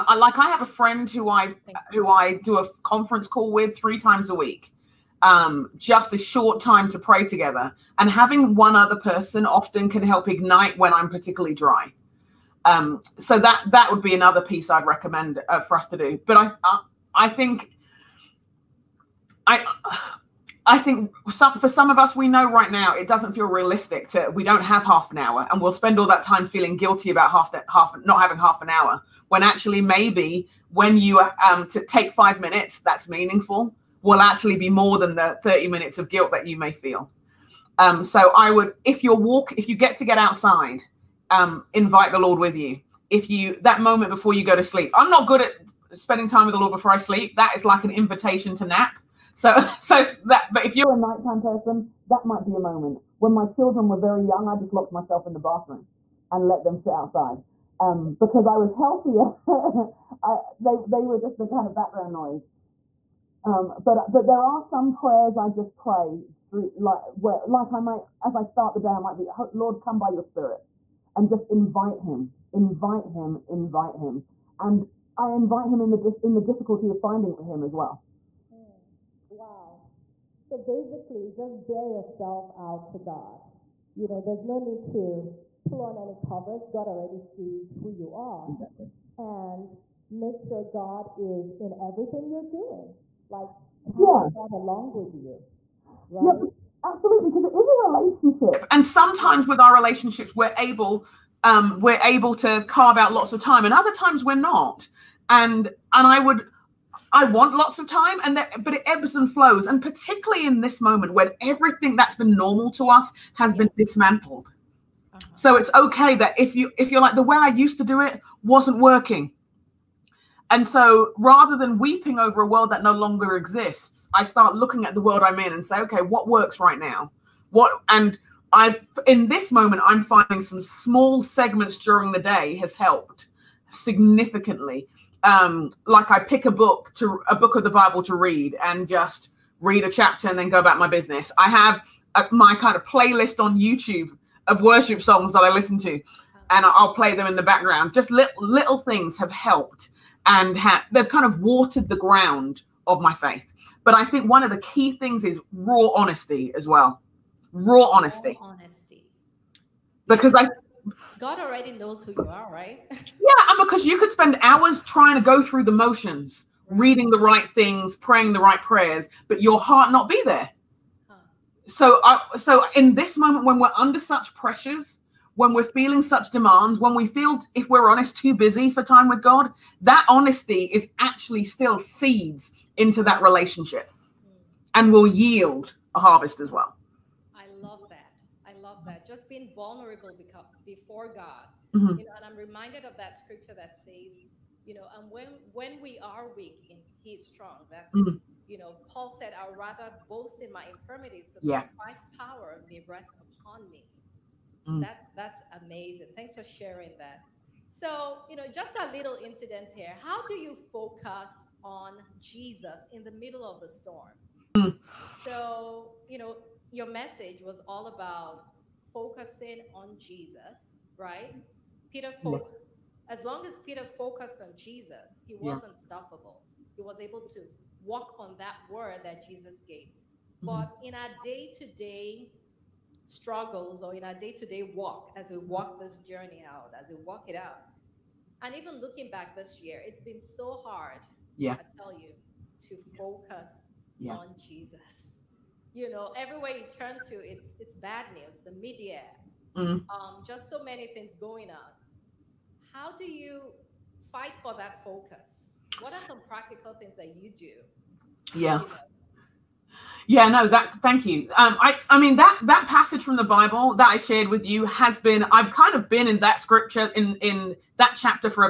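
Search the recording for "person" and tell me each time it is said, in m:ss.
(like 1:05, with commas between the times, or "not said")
0:08, 0:51.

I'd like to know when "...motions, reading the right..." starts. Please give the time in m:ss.
2:45.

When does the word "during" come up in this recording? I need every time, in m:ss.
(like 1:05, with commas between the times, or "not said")
2:11.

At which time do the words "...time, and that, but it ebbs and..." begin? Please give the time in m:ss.
1:47.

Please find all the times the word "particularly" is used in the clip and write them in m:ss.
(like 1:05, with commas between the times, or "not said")
0:11, 1:49.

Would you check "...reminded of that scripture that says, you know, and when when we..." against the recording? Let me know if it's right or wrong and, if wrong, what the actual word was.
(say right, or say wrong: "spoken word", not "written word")
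right.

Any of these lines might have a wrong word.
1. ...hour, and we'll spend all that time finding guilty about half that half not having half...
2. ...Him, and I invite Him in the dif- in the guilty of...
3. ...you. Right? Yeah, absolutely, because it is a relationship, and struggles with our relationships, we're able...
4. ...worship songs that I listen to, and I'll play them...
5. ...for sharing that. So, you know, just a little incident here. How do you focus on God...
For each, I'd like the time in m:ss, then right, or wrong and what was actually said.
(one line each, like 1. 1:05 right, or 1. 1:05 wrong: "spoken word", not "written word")
1. 0:25 wrong: "feeling", not "finding"
2. 1:13 wrong: "difficulty", not "guilty"
3. 1:35 wrong: "sometimes", not "struggles"
4. 2:24 right
5. 3:26 wrong: "Jesus", not "God".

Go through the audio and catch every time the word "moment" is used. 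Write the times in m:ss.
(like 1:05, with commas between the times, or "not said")
0:43, 0:52, 1:50, 2:09, 2:53.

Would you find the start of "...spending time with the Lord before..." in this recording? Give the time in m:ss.
0:45.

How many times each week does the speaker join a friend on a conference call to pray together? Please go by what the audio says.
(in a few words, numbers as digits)
3.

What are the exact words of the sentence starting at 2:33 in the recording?
But I think one of the key things is raw honesty as well.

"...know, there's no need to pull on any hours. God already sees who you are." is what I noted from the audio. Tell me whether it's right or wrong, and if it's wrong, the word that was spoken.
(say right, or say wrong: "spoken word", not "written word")
wrong: "covers", not "hours".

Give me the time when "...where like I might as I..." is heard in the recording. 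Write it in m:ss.
1:07.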